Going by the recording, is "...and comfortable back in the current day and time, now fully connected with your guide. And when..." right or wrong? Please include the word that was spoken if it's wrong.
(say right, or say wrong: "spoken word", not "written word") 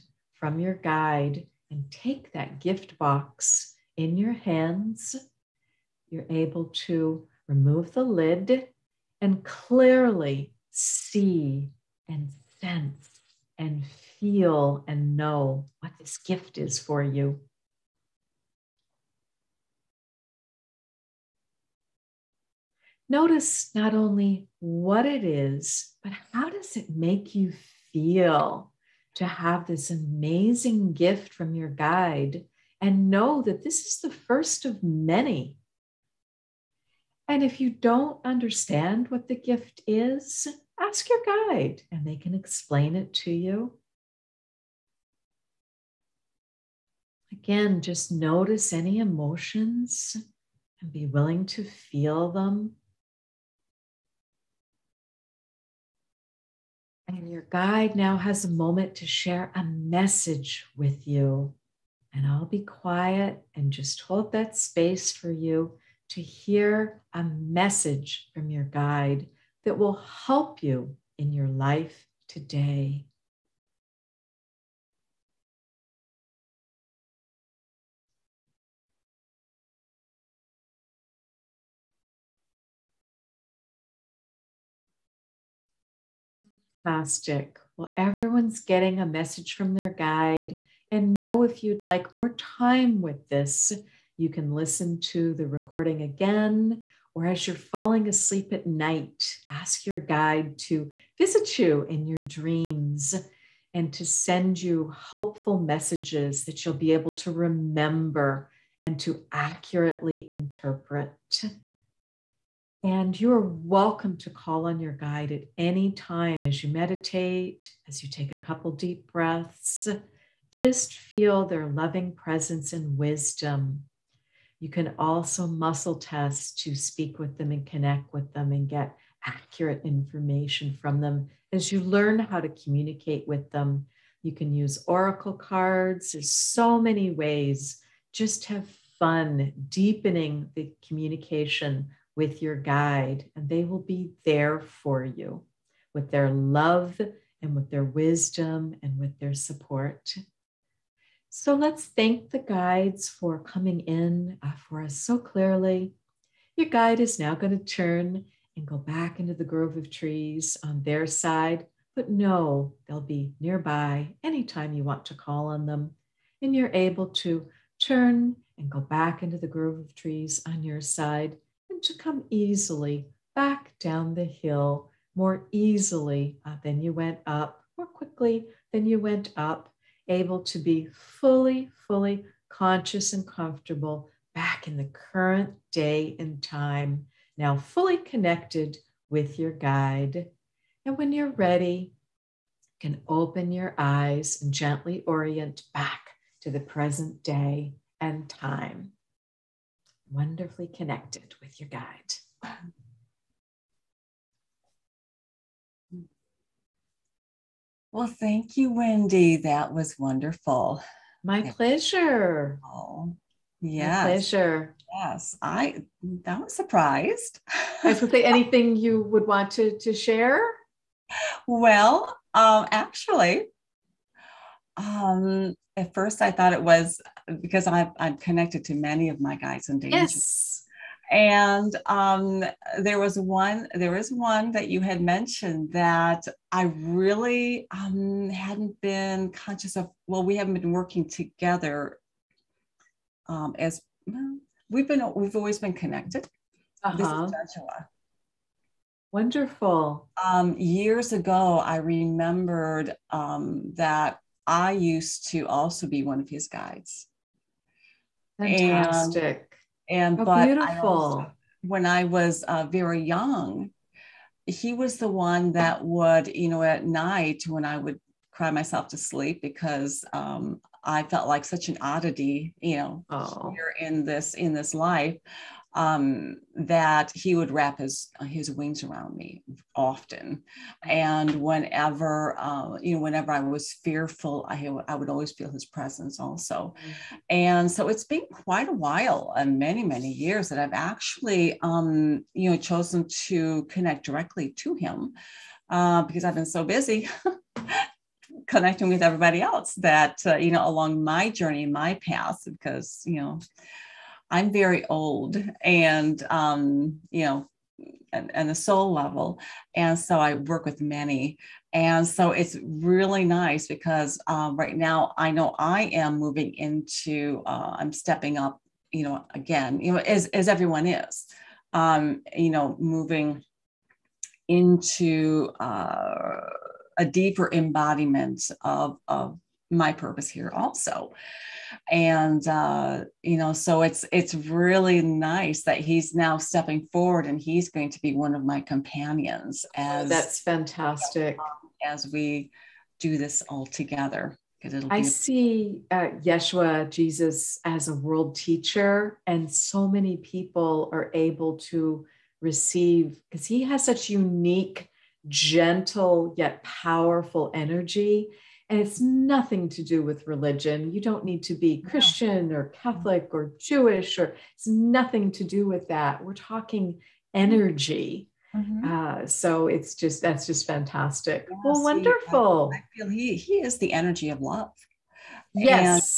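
right.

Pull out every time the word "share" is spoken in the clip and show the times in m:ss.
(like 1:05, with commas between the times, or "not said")
0:59, 3:39.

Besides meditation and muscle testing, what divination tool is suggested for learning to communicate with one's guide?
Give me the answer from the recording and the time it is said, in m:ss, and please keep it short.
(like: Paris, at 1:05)
oracle cards, at 2:14.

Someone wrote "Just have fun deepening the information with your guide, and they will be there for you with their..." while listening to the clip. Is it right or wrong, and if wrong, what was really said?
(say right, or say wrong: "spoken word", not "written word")
wrong: "communication", not "information".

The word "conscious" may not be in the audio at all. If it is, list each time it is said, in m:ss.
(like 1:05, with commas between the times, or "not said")
3:02, 3:59.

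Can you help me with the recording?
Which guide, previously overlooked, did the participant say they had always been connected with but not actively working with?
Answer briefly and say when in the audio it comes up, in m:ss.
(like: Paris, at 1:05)
Joshua, at 4:07.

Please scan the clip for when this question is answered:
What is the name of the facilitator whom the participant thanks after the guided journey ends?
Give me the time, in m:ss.
3:28.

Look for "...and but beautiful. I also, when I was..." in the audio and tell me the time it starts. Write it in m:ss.
4:20.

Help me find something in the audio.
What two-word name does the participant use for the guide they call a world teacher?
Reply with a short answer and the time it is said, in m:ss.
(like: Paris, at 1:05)
Yeshua Jesus, at 5:46.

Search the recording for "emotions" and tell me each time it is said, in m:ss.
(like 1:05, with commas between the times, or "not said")
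0:48.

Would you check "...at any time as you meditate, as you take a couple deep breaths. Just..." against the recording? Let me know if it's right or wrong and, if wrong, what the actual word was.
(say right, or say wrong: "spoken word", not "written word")
right.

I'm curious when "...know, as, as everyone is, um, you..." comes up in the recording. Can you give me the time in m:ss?
5:19.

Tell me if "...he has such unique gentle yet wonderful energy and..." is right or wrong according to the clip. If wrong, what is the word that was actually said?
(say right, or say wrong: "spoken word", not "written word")
wrong: "powerful", not "wonderful".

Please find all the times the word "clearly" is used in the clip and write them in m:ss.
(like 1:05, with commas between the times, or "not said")
0:09, 2:35.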